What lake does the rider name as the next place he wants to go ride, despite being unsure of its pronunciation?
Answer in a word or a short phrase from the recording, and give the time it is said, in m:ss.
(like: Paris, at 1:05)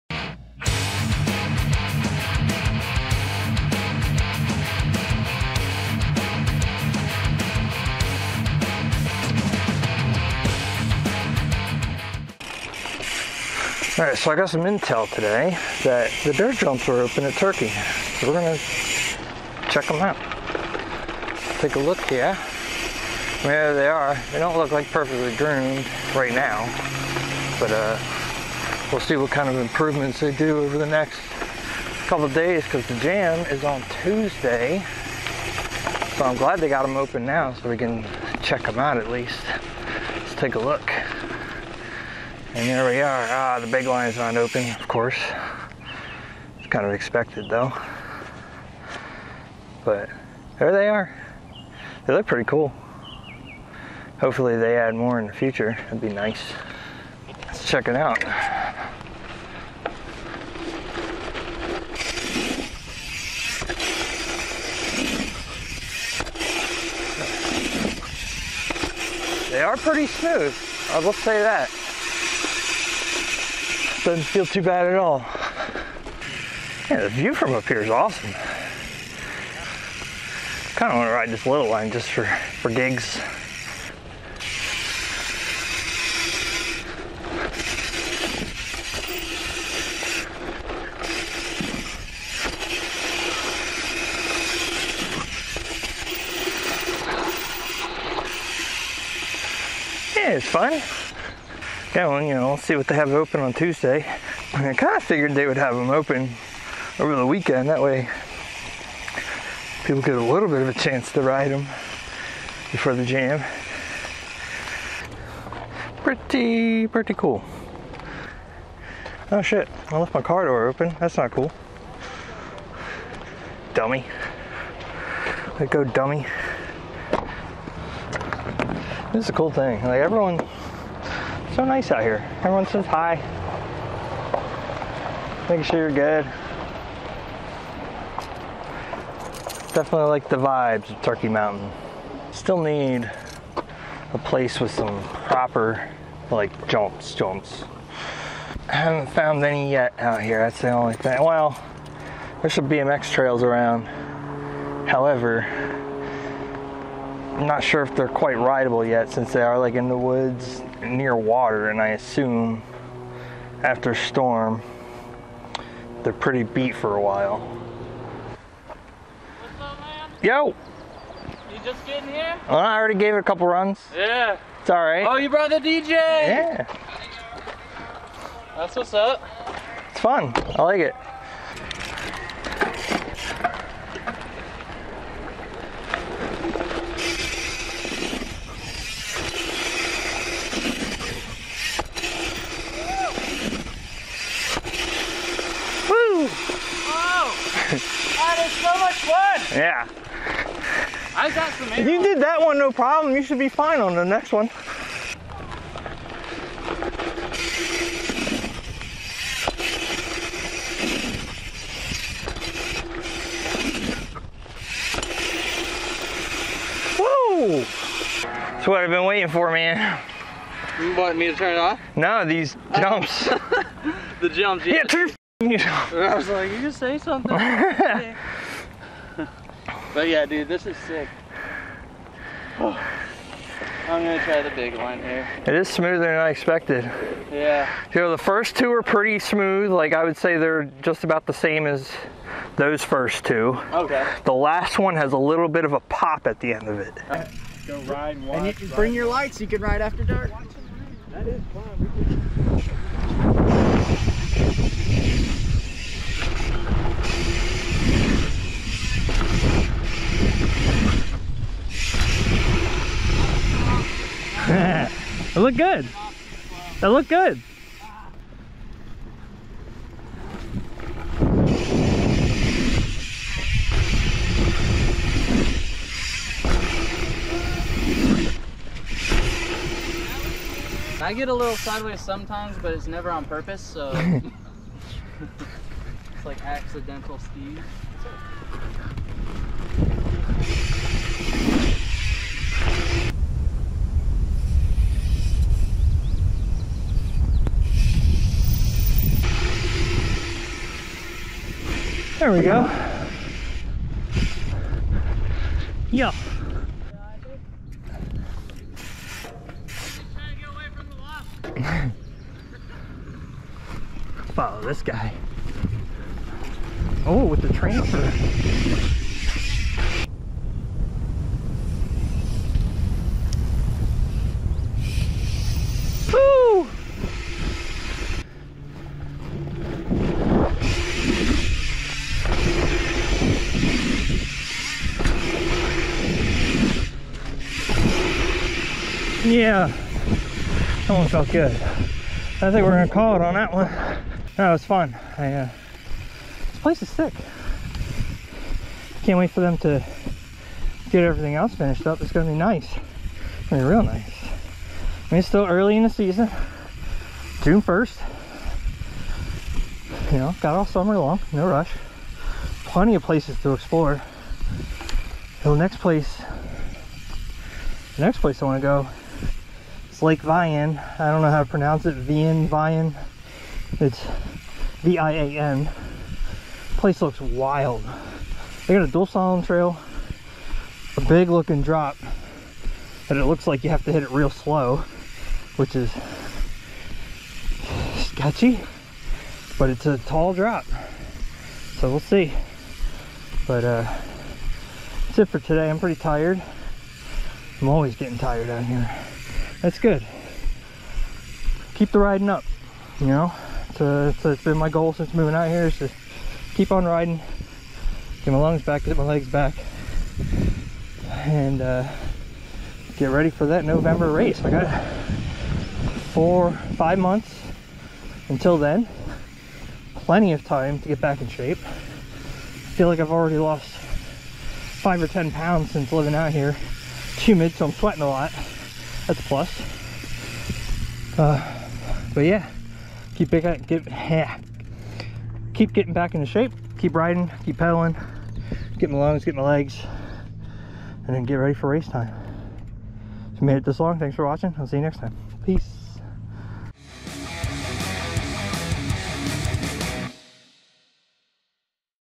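Lake Vian, at 6:10.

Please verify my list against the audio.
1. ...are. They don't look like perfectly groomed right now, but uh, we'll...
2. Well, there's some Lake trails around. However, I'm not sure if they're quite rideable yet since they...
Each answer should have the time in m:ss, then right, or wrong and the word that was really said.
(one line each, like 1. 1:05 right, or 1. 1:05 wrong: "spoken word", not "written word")
1. 0:23 right
2. 2:31 wrong: "BMX", not "Lake".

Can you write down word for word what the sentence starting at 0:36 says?
So I'm glad they got them open now so we can check them out at least.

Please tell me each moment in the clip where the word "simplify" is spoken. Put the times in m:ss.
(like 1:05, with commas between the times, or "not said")
not said.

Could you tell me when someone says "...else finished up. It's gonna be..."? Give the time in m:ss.
5:51.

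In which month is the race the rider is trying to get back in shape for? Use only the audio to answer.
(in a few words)
November.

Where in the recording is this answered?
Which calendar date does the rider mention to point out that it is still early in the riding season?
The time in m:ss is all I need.
5:57.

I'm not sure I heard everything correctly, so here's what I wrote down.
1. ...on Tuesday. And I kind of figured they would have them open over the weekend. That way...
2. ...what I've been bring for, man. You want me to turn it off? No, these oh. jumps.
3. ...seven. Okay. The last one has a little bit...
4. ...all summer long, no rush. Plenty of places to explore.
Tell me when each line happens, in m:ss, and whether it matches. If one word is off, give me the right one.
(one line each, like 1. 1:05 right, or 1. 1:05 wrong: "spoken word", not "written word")
1. 1:43 right
2. 3:38 wrong: "waiting", not "bring"
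3. 4:03 wrong: "two", not "seven"
4. 6:00 right.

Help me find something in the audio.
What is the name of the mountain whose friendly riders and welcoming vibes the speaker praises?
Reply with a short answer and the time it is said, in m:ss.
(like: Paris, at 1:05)
Turkey Mountain, at 2:21.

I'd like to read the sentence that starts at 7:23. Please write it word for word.
If you made it this long, thanks for watching.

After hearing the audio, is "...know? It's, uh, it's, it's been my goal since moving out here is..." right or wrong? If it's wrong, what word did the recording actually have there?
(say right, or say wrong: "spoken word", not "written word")
right.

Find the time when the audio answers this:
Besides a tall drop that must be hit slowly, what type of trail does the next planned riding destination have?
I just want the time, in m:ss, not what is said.
6:18.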